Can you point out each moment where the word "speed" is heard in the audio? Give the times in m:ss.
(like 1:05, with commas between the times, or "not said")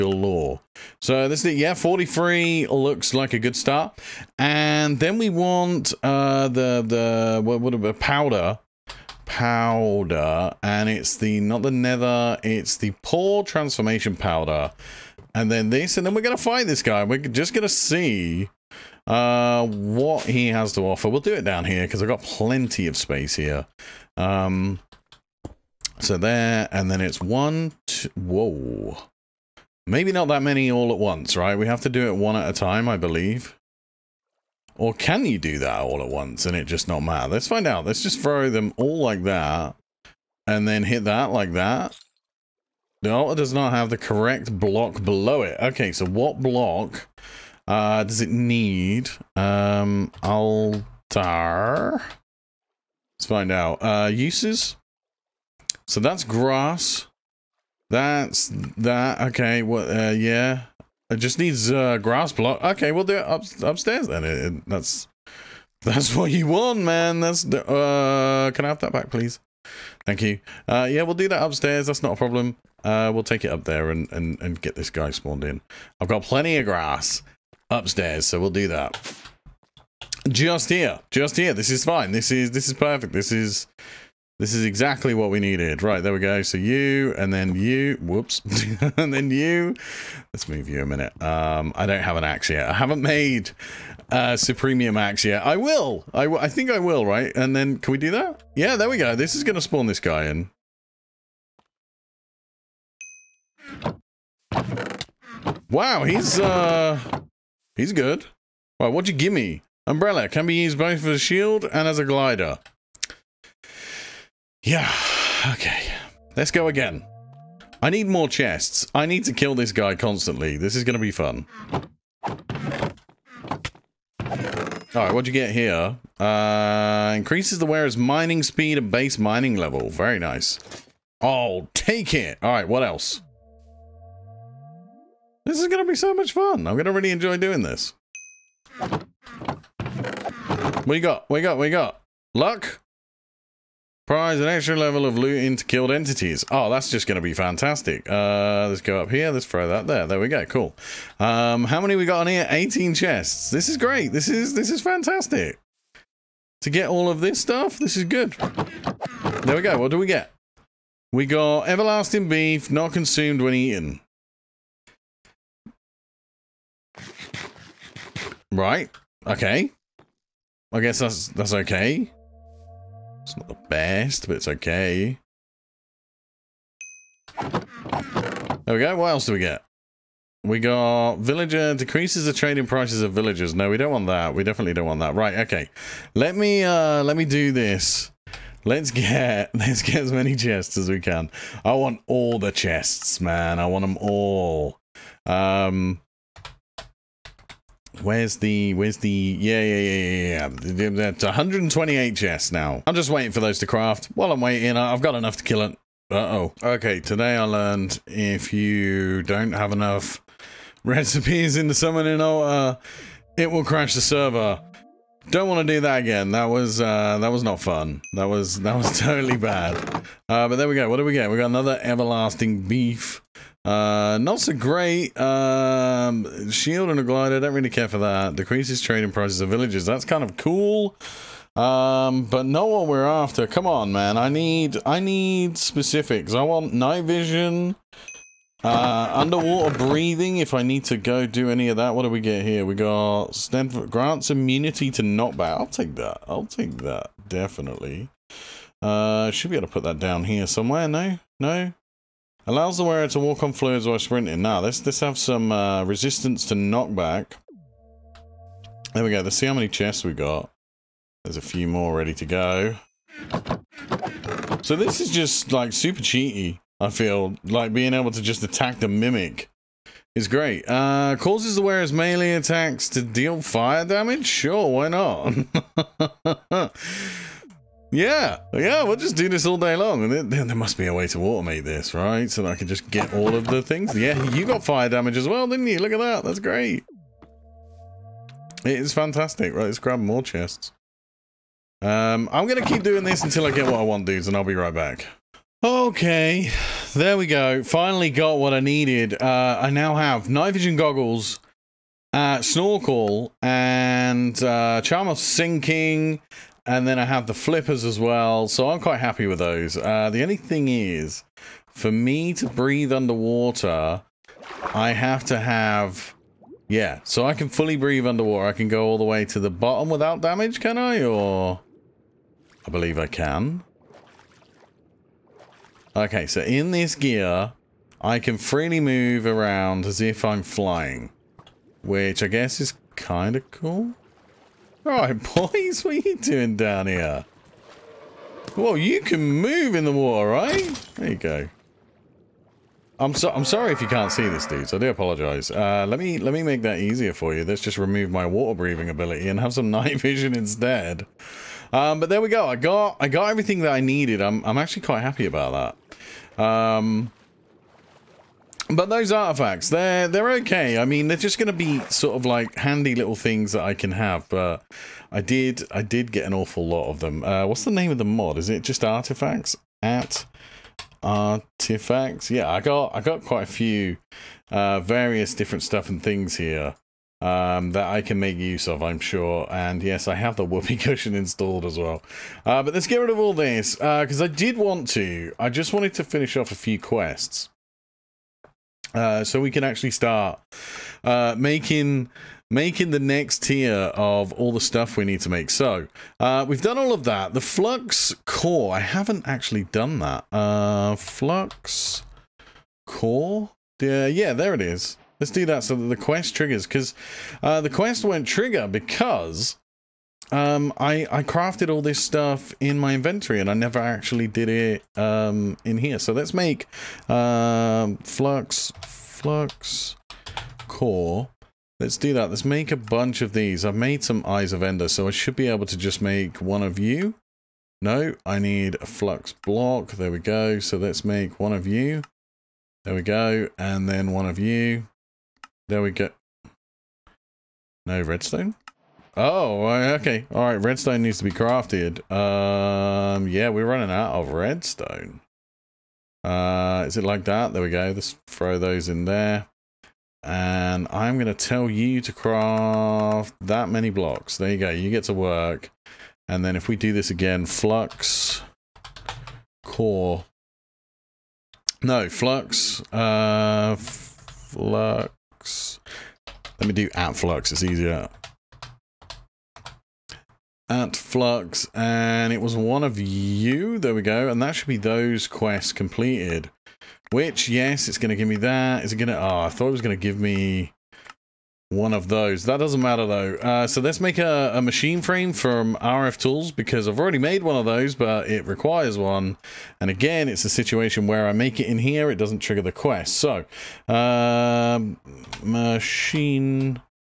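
2:08.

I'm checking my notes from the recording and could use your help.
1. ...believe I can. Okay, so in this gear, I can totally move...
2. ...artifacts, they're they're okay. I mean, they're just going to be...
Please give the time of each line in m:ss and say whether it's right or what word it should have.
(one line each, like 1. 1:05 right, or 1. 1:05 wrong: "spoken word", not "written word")
1. 5:22 wrong: "freely", not "totally"
2. 5:59 right.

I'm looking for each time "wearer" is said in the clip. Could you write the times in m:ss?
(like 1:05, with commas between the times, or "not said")
2:07, 4:12, 4:31.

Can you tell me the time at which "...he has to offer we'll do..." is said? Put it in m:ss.
0:20.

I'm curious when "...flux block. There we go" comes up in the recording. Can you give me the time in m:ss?
7:08.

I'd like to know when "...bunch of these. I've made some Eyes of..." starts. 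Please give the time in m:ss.
7:02.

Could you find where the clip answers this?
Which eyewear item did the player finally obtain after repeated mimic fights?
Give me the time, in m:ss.
5:00.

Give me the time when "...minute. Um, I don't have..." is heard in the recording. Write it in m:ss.
1:30.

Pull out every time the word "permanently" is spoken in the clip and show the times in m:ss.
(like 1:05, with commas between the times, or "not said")
not said.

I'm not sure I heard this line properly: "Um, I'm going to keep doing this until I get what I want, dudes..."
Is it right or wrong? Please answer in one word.
right.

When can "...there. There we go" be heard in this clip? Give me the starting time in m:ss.
2:29.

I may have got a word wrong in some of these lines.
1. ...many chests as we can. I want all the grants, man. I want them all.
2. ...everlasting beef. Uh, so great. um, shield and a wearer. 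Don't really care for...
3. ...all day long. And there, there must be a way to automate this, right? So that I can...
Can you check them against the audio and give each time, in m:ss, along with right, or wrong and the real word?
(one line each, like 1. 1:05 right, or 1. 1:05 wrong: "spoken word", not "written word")
1. 3:10 wrong: "chests", not "grants"
2. 3:41 wrong: "glider", not "wearer"
3. 4:39 right.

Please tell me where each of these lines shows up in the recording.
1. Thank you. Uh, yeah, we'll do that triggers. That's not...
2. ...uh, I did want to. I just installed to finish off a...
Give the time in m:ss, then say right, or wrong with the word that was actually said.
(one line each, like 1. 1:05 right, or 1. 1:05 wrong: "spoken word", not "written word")
1. 1:10 wrong: "upstairs", not "triggers"
2. 6:24 wrong: "wanted", not "installed".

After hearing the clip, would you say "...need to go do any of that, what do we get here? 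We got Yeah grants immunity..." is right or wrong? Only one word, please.
wrong.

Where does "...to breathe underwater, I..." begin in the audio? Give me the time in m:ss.
5:12.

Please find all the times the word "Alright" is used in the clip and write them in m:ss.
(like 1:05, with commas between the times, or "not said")
2:04, 2:12.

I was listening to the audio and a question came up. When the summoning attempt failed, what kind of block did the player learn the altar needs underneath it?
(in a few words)
Grass block.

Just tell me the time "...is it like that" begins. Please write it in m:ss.
7:26.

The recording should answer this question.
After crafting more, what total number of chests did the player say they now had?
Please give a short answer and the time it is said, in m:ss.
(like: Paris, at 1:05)
128, at 3:21.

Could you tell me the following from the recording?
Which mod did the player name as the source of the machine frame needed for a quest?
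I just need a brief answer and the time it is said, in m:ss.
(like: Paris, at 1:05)
RF Tools, at 8:05.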